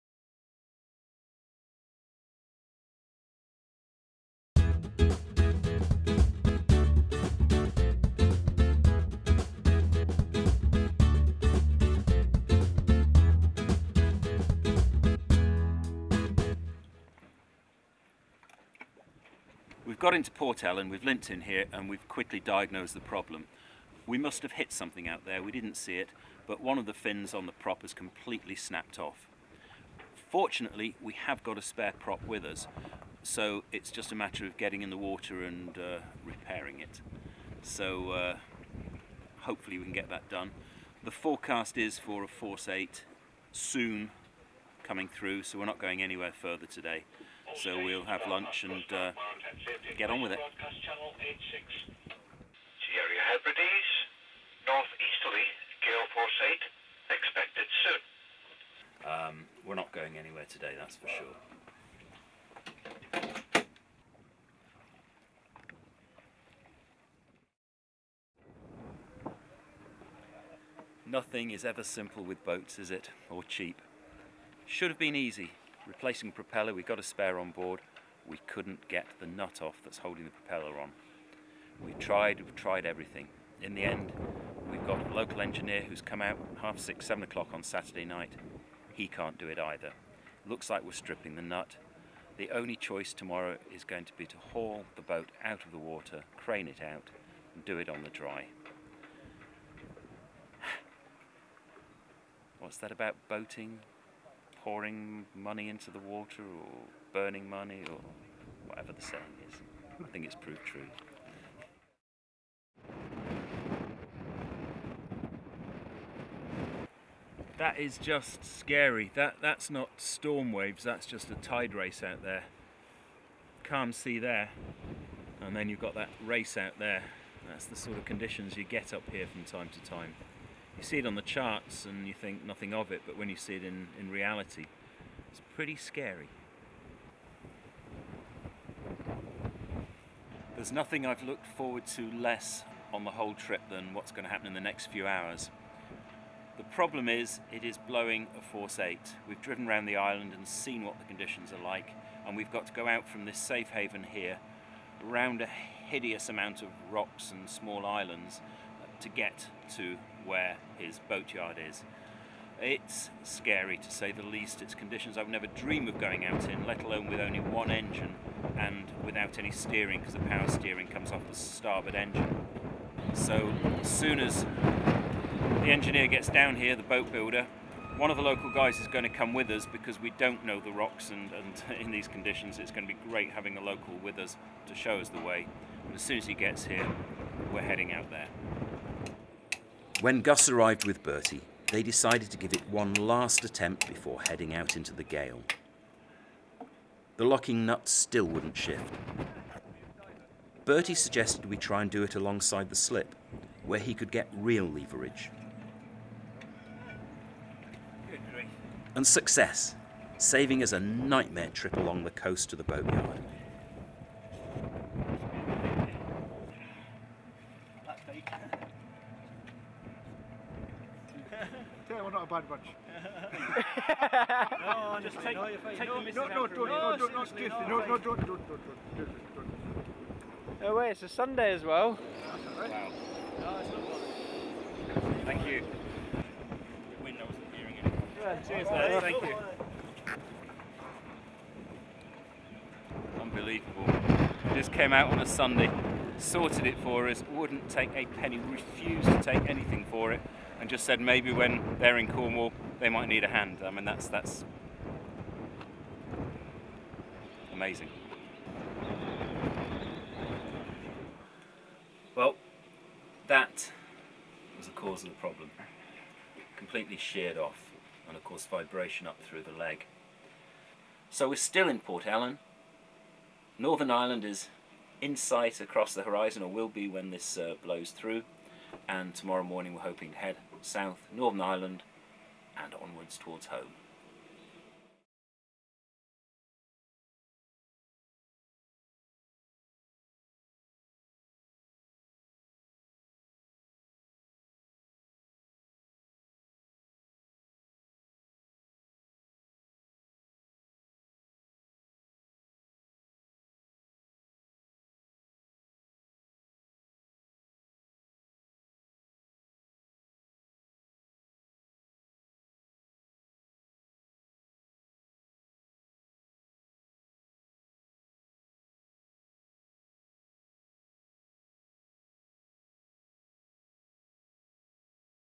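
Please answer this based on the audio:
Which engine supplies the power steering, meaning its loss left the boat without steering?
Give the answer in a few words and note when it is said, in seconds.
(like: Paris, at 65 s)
Starboard engine, at 171 s.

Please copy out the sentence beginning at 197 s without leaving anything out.
The locking nut still wouldn't shift.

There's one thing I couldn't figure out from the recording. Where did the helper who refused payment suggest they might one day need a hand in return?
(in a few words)
Cornwall.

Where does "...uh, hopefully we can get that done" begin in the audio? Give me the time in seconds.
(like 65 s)
38 s.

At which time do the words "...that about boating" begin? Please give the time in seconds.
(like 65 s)
102 s.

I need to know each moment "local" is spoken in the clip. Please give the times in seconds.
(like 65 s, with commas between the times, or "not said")
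85 s, 178 s, 183 s.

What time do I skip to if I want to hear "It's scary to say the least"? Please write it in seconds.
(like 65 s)
162 s.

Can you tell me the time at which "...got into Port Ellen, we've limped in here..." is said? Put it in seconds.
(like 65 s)
19 s.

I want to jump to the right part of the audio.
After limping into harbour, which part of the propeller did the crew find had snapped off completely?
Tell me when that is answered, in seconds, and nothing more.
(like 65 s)
26 s.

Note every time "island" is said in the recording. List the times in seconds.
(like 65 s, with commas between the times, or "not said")
149 s, 157 s.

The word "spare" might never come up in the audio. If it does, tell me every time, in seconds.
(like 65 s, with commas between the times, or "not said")
31 s, 77 s.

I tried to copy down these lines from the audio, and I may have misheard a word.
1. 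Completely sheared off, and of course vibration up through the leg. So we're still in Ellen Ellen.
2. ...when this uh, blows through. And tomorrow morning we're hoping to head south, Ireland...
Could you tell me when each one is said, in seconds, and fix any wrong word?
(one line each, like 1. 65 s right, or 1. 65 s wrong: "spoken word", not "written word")
1. 266 s wrong: "Port", not "Ellen"
2. 276 s wrong: "Northern", not "Ireland".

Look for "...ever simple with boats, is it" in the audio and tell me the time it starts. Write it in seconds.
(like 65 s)
71 s.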